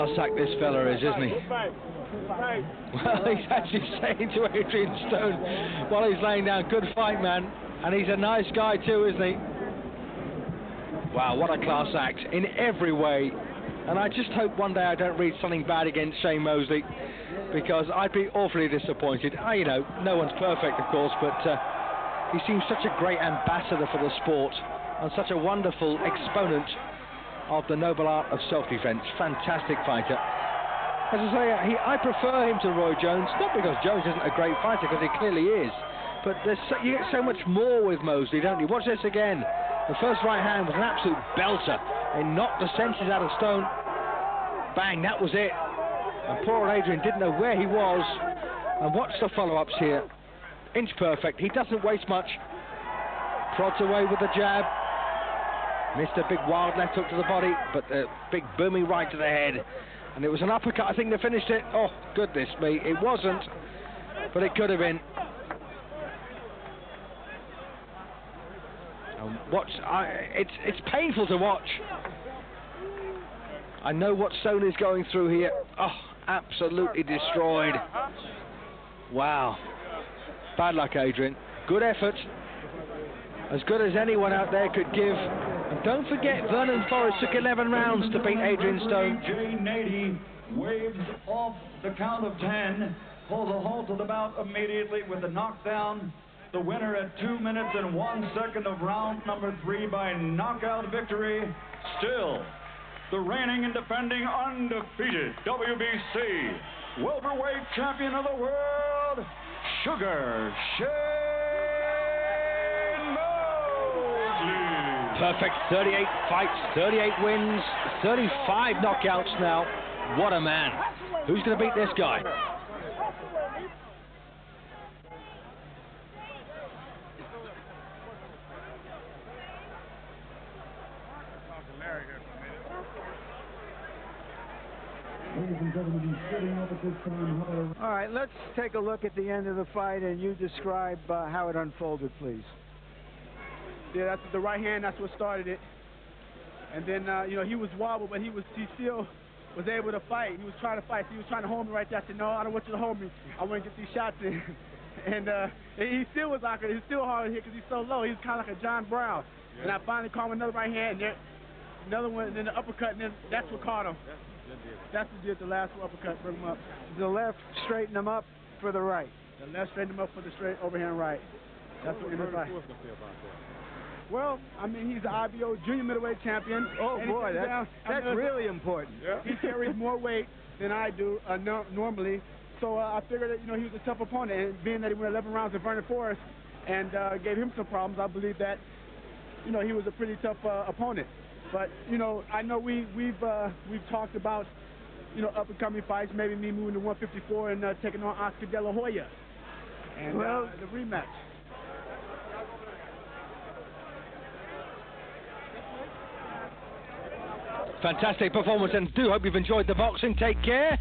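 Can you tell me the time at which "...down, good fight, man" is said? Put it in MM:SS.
00:06.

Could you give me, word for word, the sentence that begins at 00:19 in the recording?
I, you know, no one's perfect, of course, but...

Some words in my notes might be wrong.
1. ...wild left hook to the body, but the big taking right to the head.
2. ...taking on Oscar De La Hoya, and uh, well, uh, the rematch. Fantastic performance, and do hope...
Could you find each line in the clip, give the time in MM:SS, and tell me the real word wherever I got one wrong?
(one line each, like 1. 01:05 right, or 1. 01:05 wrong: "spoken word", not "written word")
1. 00:56 wrong: "booming", not "taking"
2. 03:17 right.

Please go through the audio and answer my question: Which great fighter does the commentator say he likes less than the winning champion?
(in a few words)
Roy Jones.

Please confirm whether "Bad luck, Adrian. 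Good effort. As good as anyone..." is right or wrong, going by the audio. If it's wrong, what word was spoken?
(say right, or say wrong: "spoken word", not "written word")
right.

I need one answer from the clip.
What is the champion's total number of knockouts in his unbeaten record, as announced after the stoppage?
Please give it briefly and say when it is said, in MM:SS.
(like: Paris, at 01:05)
35, at 01:58.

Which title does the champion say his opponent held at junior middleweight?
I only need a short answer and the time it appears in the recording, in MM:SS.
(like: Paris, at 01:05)
IBO, at 02:55.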